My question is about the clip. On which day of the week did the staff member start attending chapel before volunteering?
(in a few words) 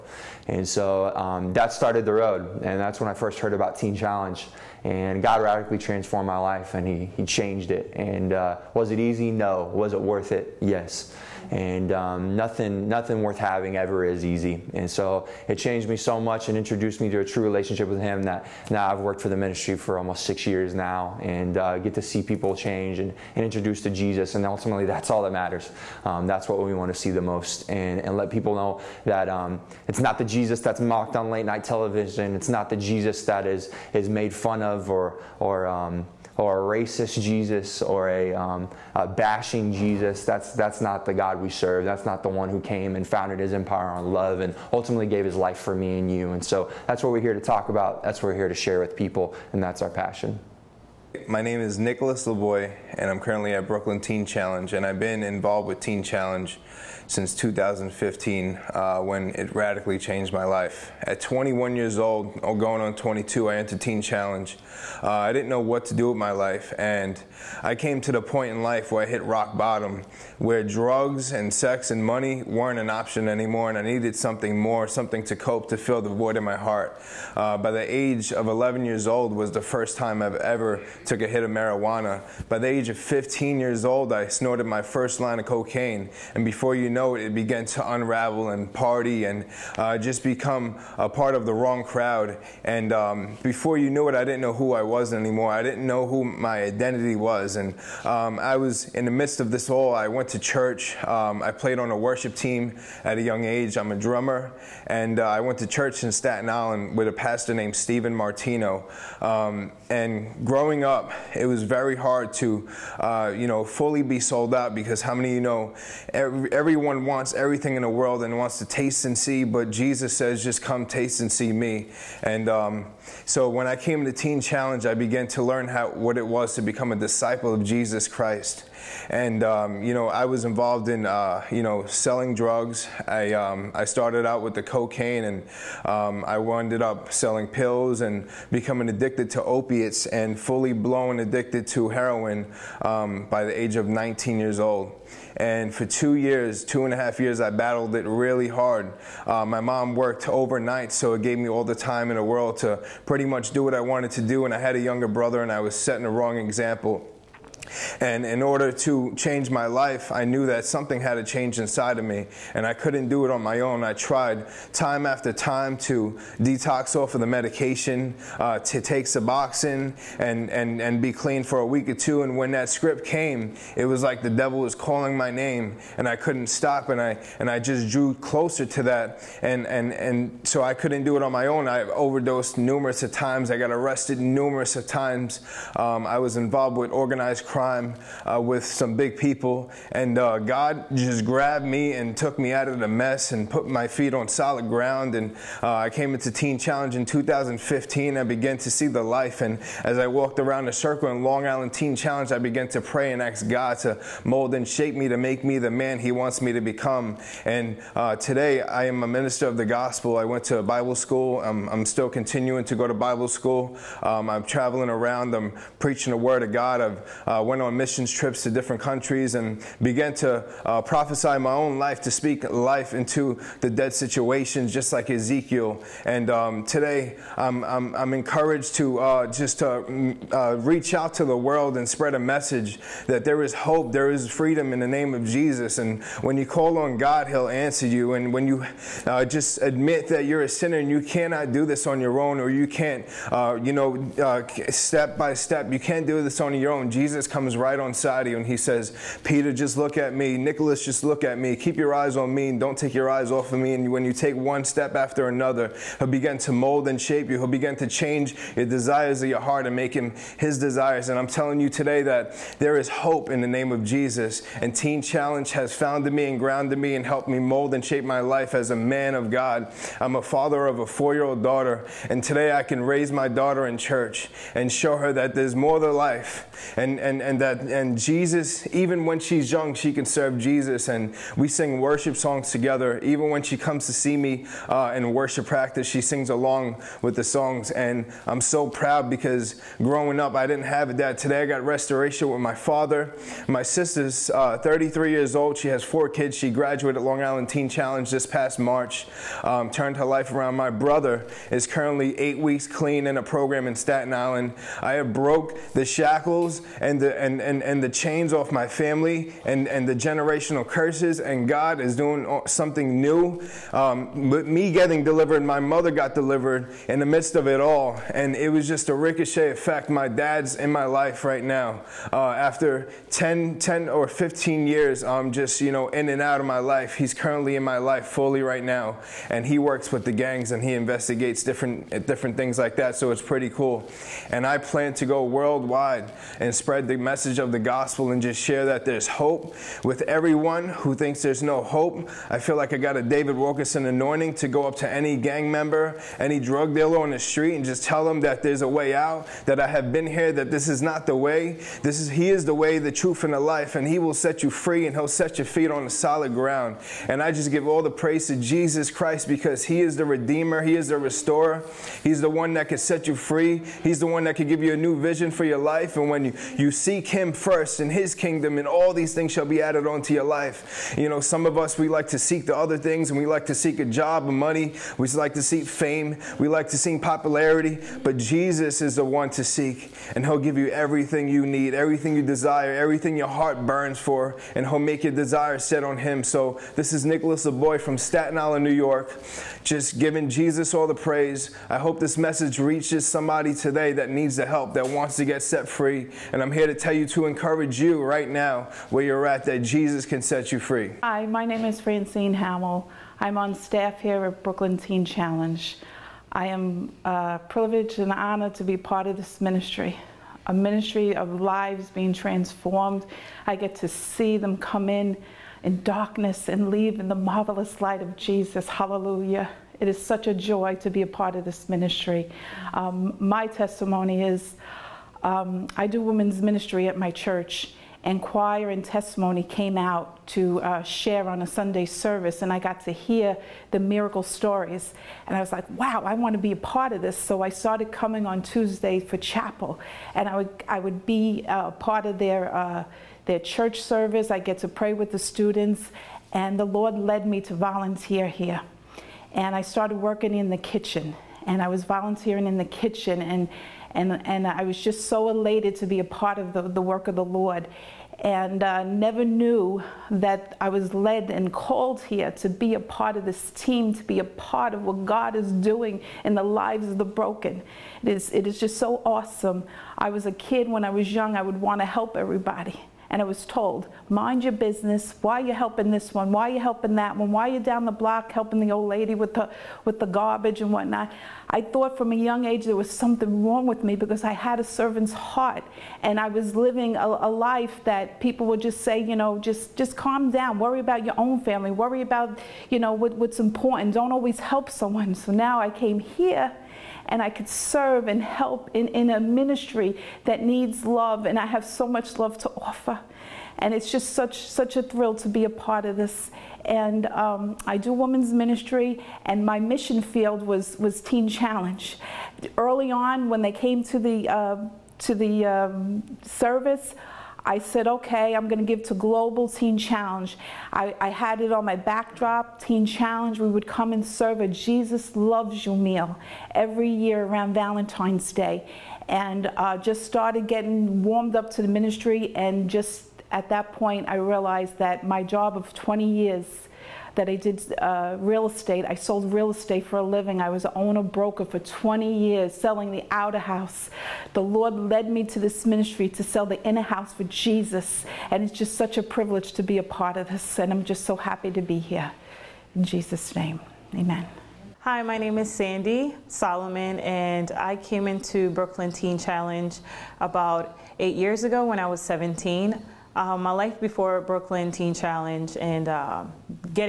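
Tuesday.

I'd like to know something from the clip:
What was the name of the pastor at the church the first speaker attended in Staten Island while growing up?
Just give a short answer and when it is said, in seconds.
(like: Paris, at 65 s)
Stephen Martino, at 107 s.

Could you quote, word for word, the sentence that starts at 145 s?
And for two years, two and a half years, I battled it really hard.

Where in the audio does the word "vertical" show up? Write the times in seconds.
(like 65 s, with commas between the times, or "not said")
not said.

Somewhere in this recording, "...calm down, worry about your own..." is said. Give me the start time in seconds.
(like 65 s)
489 s.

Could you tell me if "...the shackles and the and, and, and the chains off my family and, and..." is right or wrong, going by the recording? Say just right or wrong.
right.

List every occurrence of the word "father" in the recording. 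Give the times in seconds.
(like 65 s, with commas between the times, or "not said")
270 s, 292 s.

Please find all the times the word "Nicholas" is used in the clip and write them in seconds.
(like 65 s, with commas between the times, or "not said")
51 s, 250 s, 387 s.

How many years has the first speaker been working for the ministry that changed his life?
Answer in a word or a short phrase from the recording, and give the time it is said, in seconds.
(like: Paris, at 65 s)
almost 6 years, at 19 s.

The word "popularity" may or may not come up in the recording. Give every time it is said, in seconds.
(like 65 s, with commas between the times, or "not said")
377 s.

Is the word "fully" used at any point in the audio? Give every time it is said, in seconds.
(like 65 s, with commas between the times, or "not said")
113 s, 140 s, 328 s.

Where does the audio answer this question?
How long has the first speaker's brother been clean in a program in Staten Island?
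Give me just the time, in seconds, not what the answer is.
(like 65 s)
302 s.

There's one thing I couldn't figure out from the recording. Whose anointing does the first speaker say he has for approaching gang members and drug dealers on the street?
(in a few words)
David Wilkerson.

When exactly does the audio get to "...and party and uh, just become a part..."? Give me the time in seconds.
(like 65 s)
88 s.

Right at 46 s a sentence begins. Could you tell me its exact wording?
And so that's what we're here to talk about.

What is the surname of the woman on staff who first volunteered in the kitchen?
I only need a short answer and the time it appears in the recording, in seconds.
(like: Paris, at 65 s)
Hamill, at 402 s.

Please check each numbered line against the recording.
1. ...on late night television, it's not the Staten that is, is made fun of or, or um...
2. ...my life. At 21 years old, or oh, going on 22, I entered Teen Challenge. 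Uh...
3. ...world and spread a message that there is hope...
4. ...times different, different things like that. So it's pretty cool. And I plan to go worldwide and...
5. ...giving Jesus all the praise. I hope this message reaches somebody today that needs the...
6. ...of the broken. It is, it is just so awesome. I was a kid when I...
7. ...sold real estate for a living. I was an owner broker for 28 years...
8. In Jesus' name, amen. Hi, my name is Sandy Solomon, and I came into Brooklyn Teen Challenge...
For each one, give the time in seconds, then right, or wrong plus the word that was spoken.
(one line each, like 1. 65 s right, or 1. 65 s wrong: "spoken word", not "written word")
1. 31 s wrong: "Jesus", not "Staten"
2. 60 s right
3. 231 s right
4. 330 s wrong: "investigates", not "times"
5. 389 s right
6. 466 s right
7. 538 s wrong: "20", not "28"
8. 552 s right.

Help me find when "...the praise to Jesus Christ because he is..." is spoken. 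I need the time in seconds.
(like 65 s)
357 s.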